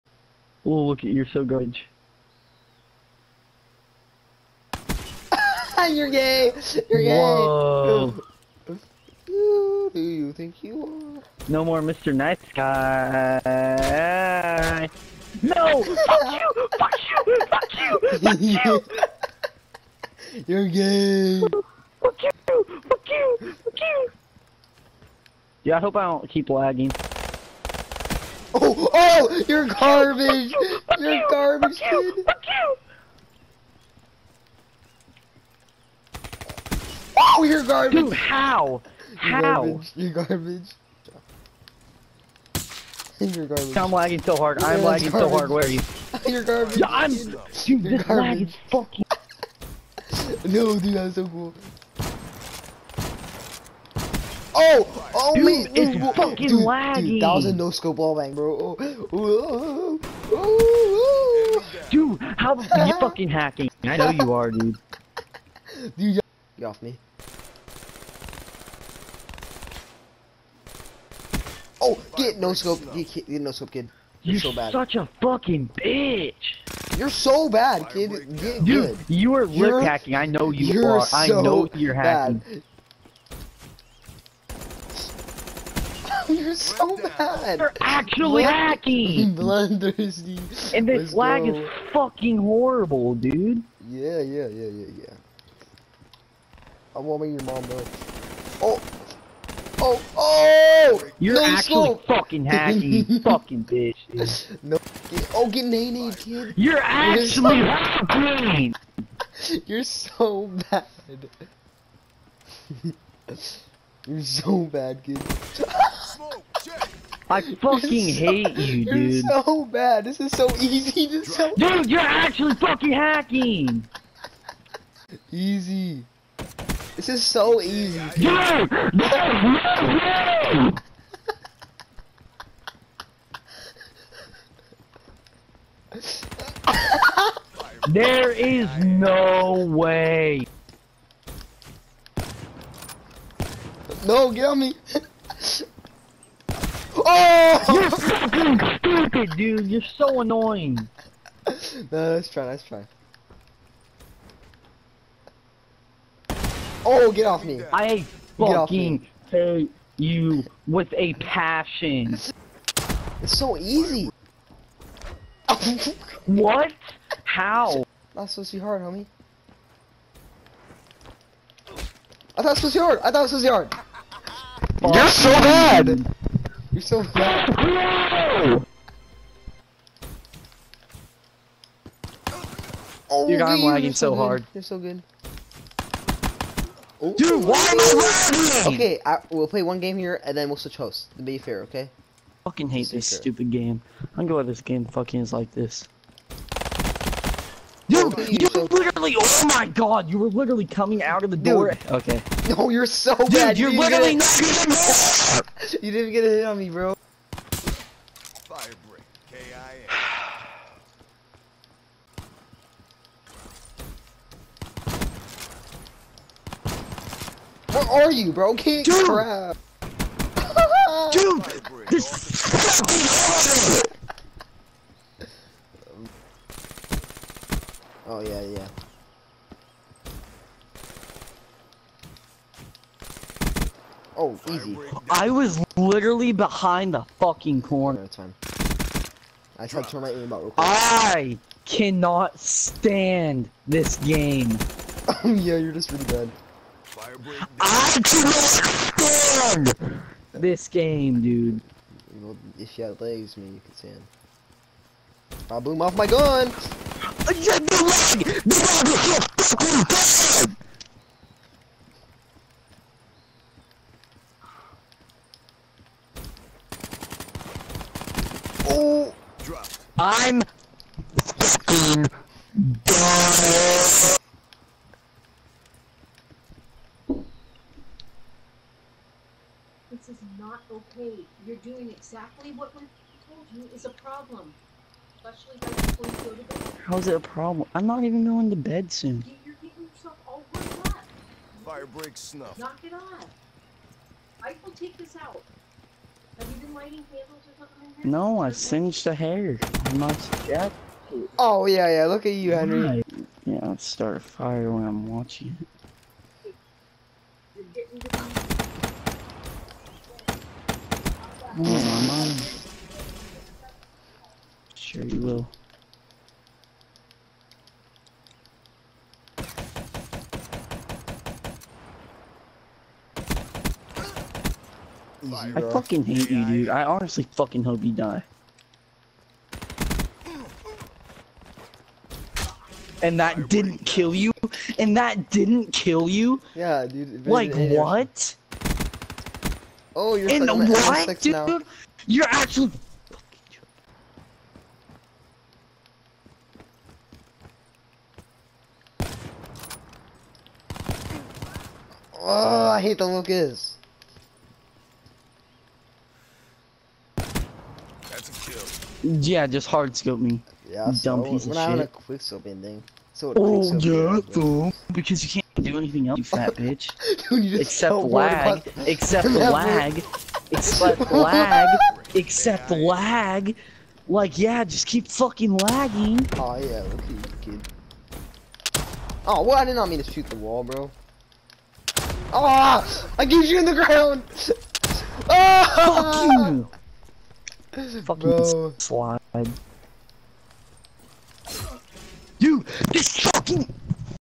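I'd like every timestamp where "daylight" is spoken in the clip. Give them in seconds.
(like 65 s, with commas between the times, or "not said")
not said.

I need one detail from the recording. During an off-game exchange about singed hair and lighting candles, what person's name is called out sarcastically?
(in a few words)
Henry.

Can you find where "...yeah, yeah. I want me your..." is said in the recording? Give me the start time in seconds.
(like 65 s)
94 s.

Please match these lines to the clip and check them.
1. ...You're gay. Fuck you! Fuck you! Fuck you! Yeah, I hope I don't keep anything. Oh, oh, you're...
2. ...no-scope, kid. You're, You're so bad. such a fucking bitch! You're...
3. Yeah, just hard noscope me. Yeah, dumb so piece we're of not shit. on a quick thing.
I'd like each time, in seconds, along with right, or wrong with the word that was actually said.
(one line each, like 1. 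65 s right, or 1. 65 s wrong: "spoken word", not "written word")
1. 20 s wrong: "lagging", not "anything"
2. 73 s right
3. 359 s wrong: "scope", not "noscope".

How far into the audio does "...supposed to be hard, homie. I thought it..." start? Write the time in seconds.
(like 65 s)
168 s.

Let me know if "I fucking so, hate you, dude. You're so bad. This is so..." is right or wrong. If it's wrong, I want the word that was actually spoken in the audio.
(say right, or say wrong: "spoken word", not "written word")
right.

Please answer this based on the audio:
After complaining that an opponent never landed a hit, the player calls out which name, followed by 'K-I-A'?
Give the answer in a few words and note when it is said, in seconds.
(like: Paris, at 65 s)
Firebrick, at 208 s.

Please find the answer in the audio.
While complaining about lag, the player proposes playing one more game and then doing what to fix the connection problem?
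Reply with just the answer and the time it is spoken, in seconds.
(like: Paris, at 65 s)
switch hosts, at 190 s.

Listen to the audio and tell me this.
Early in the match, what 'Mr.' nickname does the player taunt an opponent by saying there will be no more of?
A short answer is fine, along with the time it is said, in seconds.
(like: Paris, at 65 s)
Mr. Night Sky, at 11 s.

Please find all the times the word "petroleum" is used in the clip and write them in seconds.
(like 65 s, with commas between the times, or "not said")
not said.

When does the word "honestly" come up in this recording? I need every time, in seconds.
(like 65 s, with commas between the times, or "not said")
326 s.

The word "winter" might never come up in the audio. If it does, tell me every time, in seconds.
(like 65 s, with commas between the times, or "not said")
not said.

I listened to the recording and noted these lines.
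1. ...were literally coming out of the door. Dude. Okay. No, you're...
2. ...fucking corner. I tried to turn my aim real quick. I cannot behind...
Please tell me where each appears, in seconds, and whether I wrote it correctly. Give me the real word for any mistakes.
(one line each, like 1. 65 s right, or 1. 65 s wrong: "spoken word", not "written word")
1. 200 s right
2. 237 s wrong: "stand", not "behind".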